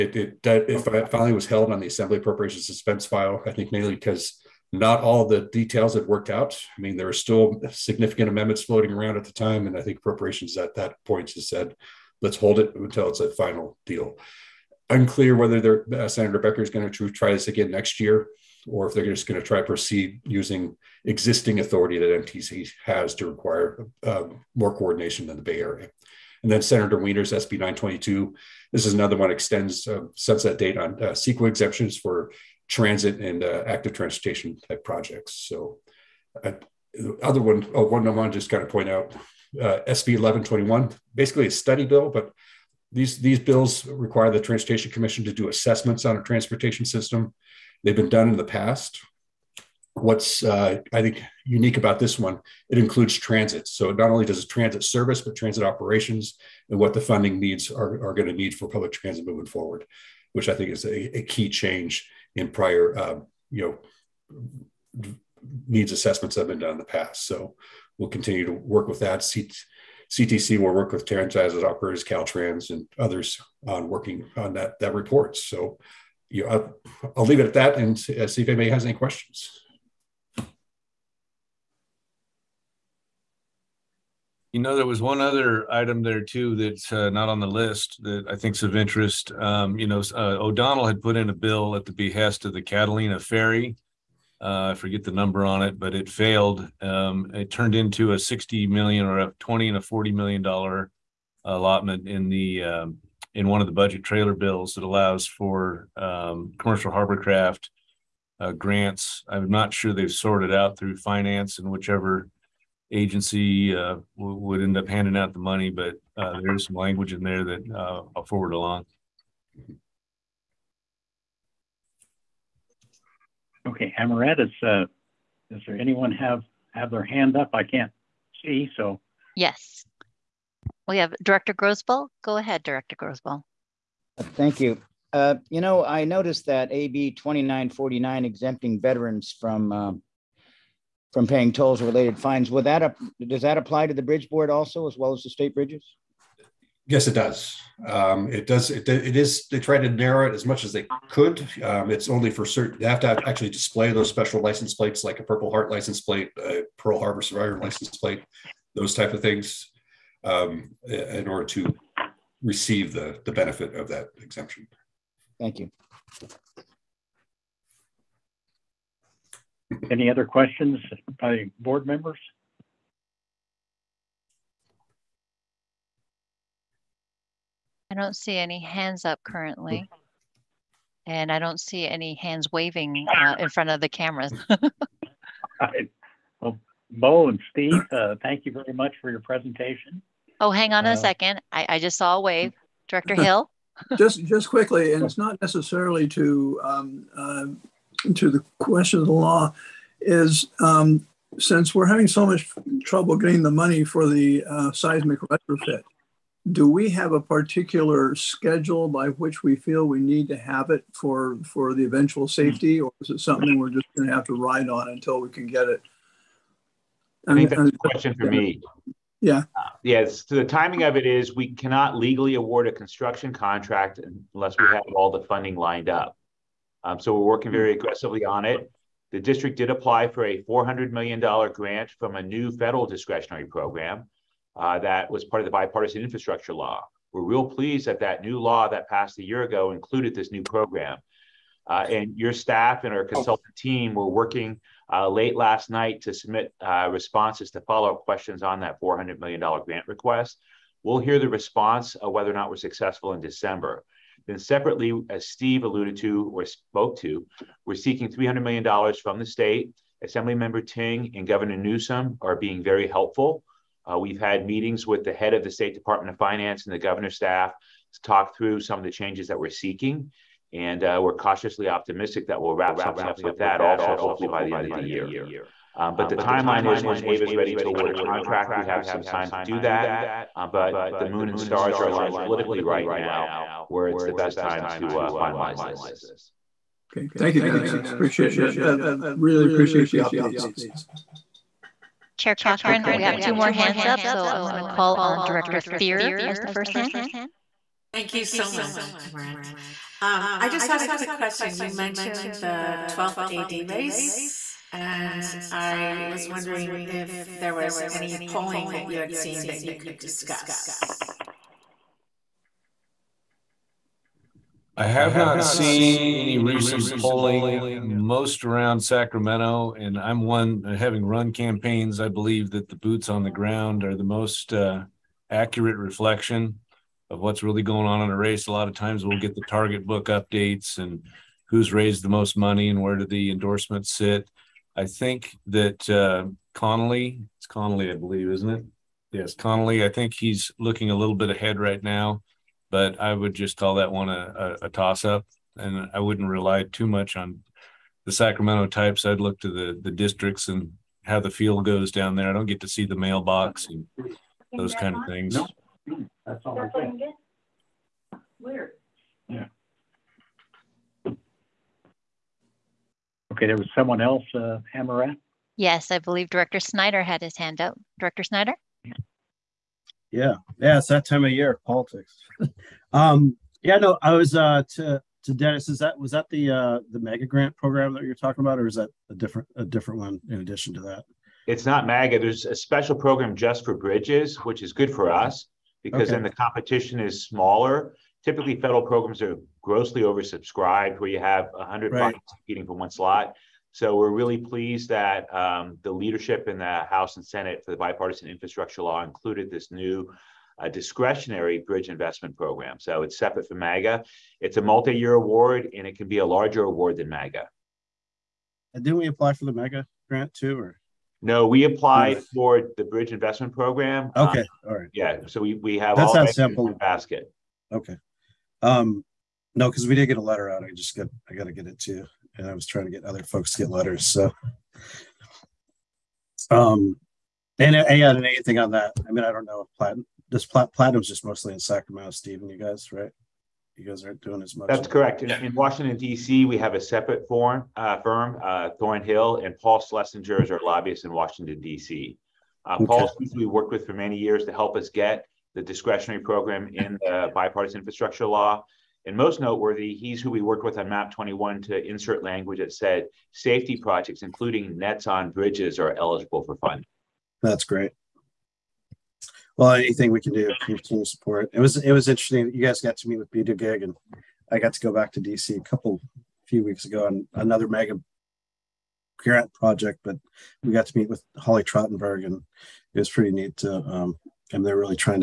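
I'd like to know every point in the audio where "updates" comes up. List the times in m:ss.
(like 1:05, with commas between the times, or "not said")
4:49, 5:30.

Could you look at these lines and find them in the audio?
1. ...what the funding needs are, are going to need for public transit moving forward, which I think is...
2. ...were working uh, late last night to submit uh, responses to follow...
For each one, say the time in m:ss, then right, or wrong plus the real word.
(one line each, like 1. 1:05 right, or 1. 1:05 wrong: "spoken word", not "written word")
1. 0:56 right
2. 4:03 right.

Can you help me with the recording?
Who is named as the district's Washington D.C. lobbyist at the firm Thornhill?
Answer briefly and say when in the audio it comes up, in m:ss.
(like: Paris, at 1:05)
Paul Schlesinger, at 7:19.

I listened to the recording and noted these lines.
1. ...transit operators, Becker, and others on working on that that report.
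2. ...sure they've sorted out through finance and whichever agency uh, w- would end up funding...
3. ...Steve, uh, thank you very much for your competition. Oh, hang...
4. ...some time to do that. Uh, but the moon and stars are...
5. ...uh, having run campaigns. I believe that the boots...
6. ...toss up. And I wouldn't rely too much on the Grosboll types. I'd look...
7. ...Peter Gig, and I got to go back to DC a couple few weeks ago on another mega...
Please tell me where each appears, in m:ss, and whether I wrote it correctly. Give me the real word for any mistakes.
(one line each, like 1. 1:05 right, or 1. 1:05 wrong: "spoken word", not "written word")
1. 1:11 wrong: "Caltrans", not "Becker"
2. 1:49 wrong: "handing", not "funding"
3. 3:07 wrong: "presentation", not "competition"
4. 4:38 right
5. 5:20 right
6. 5:44 wrong: "Sacramento", not "Grosboll"
7. 7:43 right.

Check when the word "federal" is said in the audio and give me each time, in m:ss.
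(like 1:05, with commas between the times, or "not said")
3:52, 6:28.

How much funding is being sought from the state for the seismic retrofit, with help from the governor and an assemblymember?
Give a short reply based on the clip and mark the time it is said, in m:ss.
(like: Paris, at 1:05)
$300 million, at 4:18.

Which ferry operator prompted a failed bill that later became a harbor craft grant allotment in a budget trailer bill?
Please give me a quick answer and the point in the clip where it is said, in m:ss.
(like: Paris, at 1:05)
Catalina Ferry, at 1:32.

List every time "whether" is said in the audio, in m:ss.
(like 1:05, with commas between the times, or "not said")
0:15, 4:12.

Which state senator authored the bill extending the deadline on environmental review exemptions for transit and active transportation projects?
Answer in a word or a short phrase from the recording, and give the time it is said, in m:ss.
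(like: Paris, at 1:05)
Senator Wiener, at 0:26.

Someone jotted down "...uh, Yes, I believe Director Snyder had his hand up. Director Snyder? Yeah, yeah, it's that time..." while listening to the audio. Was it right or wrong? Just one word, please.
right.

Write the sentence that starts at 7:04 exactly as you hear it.
So, um, and yeah, and anything on that?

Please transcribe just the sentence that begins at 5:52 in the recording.
I don't get to see the mailbox and those kind of things.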